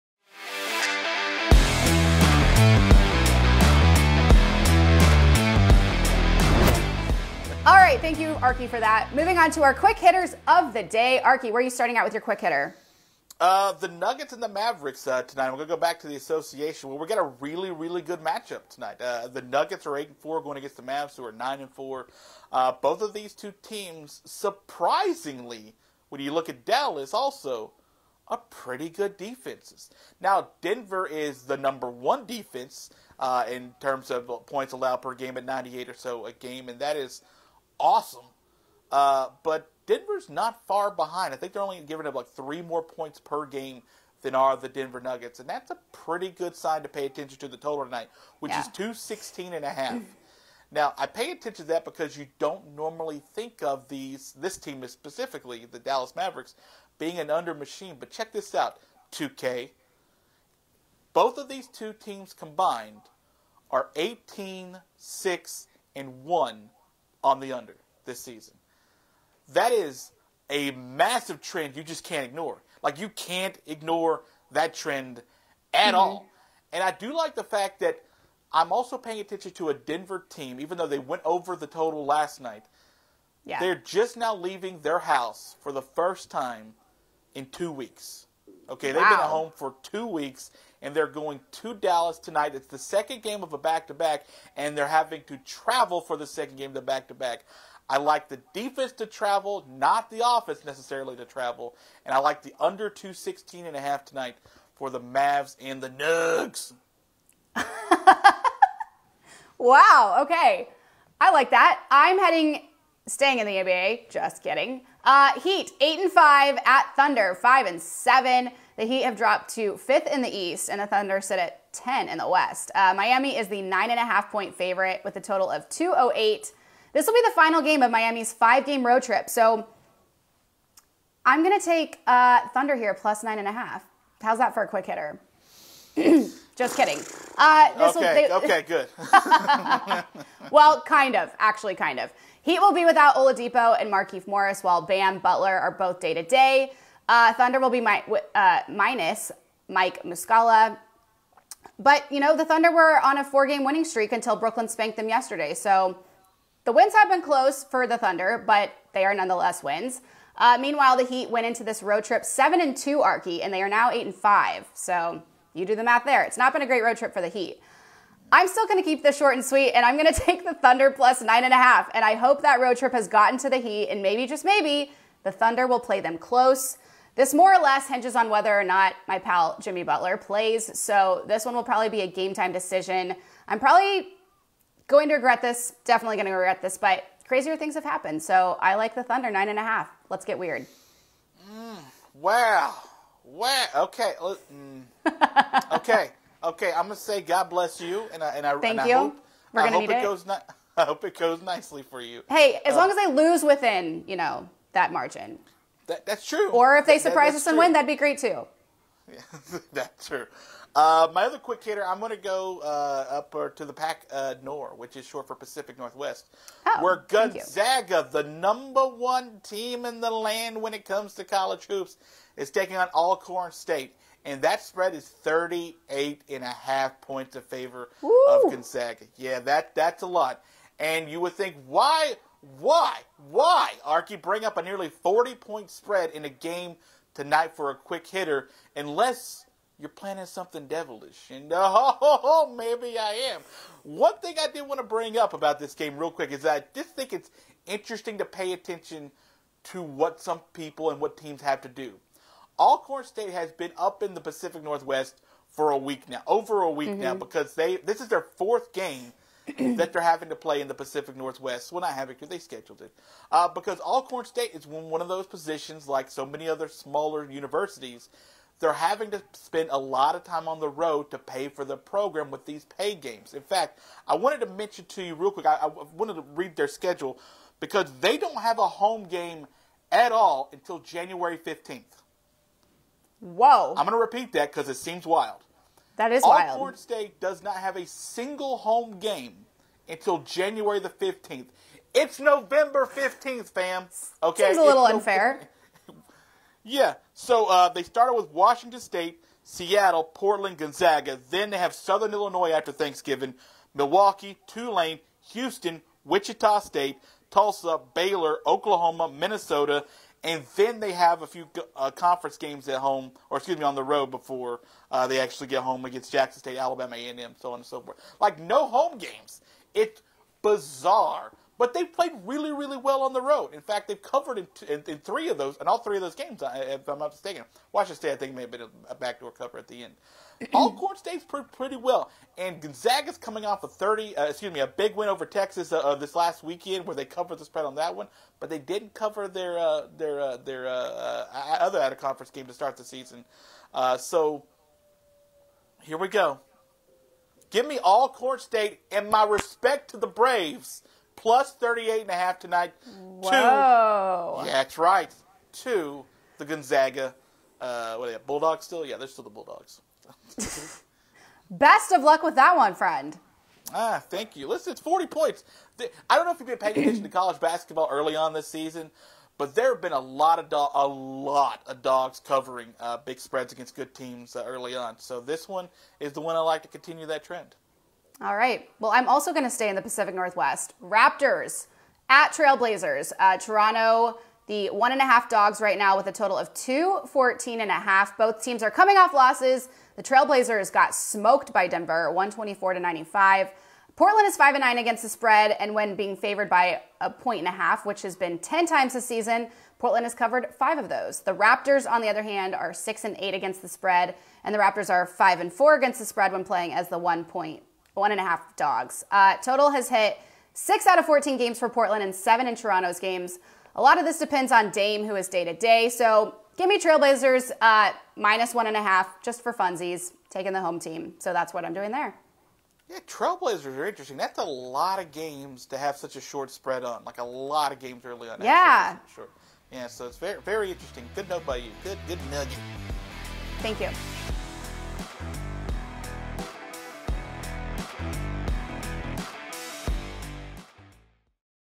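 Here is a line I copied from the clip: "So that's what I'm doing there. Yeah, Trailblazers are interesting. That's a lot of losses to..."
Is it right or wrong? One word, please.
wrong.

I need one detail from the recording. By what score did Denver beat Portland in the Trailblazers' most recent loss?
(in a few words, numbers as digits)
124-95.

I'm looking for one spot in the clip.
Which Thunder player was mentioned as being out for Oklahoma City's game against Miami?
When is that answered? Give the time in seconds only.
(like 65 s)
149 s.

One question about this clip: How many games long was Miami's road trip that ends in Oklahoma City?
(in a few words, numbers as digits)
5.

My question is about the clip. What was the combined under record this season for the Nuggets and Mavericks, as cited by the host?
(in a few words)
18-6-1.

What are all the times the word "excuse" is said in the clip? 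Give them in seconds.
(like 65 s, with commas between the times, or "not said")
313 s, 334 s.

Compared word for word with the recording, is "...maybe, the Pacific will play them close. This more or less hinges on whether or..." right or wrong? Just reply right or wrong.
wrong.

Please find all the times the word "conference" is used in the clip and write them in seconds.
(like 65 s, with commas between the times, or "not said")
311 s, 341 s.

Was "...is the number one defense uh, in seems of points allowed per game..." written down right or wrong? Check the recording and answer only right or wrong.
wrong.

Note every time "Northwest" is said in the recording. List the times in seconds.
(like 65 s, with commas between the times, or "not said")
215 s, 254 s, 261 s, 380 s.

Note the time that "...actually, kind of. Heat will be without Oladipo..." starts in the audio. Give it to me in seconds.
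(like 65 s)
141 s.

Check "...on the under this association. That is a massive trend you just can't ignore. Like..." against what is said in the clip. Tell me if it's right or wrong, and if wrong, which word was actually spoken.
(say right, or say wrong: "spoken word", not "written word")
wrong: "season", not "association".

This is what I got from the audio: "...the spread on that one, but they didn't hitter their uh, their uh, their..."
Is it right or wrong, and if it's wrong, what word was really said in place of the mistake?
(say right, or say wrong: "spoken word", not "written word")
wrong: "cover", not "hitter".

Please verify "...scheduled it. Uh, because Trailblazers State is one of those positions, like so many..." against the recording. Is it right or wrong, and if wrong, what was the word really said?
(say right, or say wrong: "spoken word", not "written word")
wrong: "Alcorn", not "Trailblazers".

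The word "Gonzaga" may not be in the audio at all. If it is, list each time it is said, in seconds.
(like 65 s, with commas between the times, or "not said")
217 s, 228 s, 300 s, 332 s, 356 s.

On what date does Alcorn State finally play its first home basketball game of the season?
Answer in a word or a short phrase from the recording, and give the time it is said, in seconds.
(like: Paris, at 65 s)
January 15, at 280 s.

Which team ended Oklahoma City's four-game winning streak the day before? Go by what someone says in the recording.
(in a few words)
Brooklyn.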